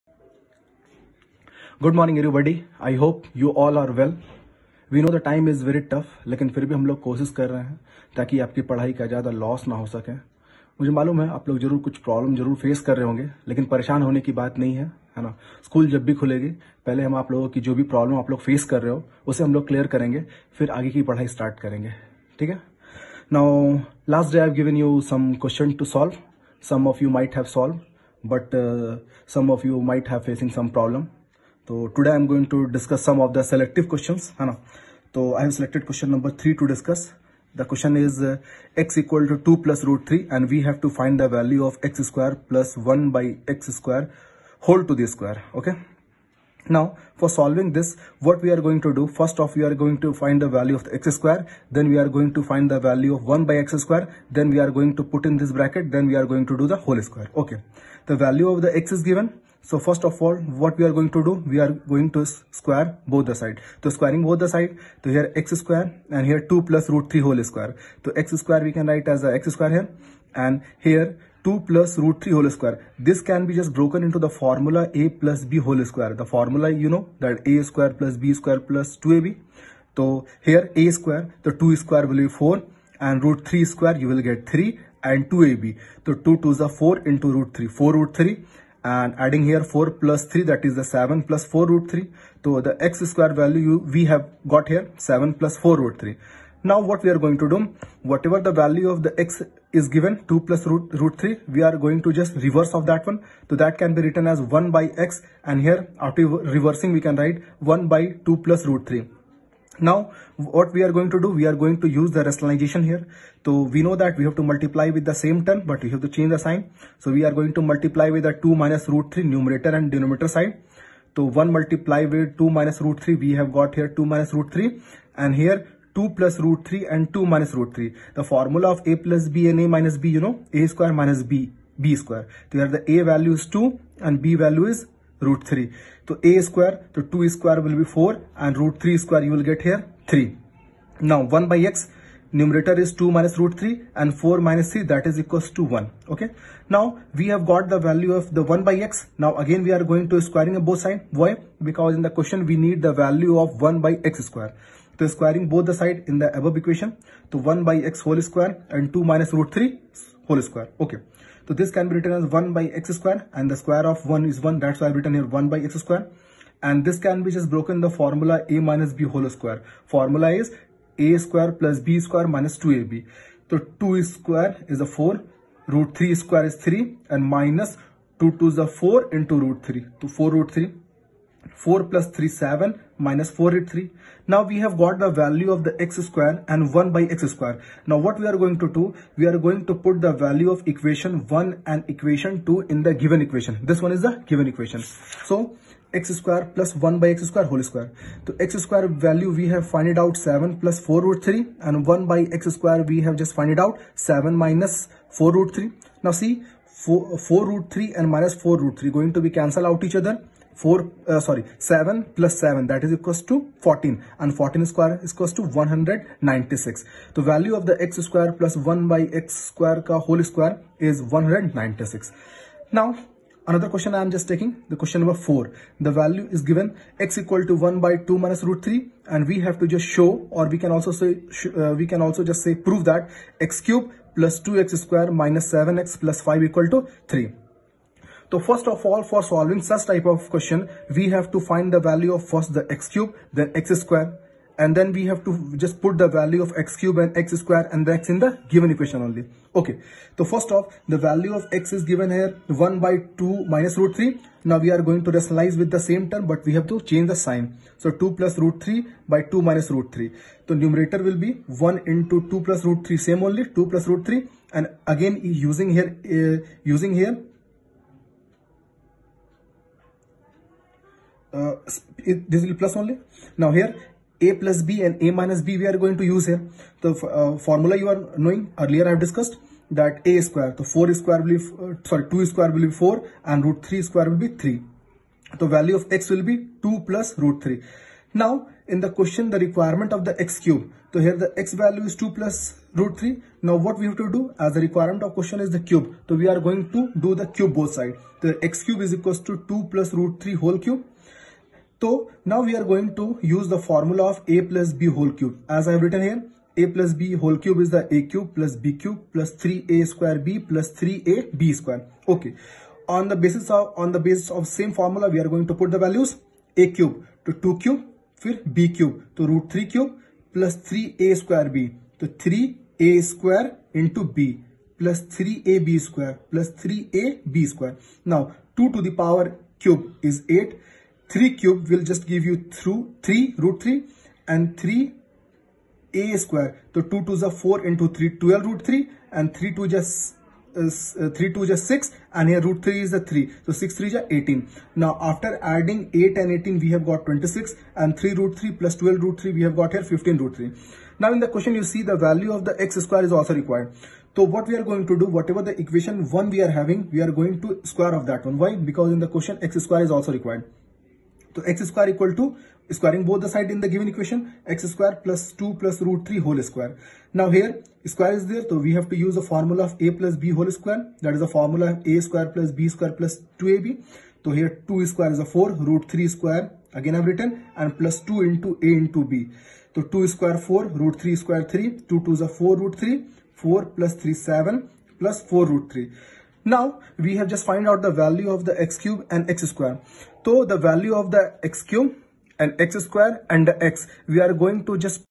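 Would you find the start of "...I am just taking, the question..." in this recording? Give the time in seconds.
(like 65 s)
223 s.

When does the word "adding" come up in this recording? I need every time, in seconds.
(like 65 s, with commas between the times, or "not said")
89 s, 345 s.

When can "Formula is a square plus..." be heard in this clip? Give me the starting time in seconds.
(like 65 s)
169 s.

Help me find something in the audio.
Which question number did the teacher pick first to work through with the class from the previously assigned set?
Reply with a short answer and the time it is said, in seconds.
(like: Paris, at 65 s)
3, at 35 s.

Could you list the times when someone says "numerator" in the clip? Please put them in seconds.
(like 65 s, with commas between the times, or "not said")
119 s, 142 s, 260 s.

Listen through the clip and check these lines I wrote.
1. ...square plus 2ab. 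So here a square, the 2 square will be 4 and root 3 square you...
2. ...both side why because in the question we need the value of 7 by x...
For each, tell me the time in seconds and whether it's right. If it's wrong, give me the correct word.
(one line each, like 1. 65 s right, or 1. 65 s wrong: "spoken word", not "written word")
1. 78 s right
2. 150 s wrong: "1", not "7".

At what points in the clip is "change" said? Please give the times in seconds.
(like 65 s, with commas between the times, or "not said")
116 s, 256 s.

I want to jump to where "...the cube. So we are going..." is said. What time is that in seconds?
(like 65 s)
295 s.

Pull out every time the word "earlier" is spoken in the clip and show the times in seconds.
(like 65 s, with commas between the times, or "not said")
278 s.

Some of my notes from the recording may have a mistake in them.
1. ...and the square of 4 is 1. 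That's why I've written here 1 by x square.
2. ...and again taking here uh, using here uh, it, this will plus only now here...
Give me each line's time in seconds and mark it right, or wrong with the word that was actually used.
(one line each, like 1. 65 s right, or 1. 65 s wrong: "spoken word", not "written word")
1. 163 s wrong: "1", not "4"
2. 264 s wrong: "using", not "taking".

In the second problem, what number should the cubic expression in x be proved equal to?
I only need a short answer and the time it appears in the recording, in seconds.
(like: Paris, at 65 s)
3, at 236 s.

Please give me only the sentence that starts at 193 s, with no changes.
This one is the given equation.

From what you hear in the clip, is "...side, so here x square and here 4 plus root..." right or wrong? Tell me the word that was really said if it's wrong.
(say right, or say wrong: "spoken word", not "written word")
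wrong: "2", not "4".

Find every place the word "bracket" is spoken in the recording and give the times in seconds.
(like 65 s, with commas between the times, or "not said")
55 s.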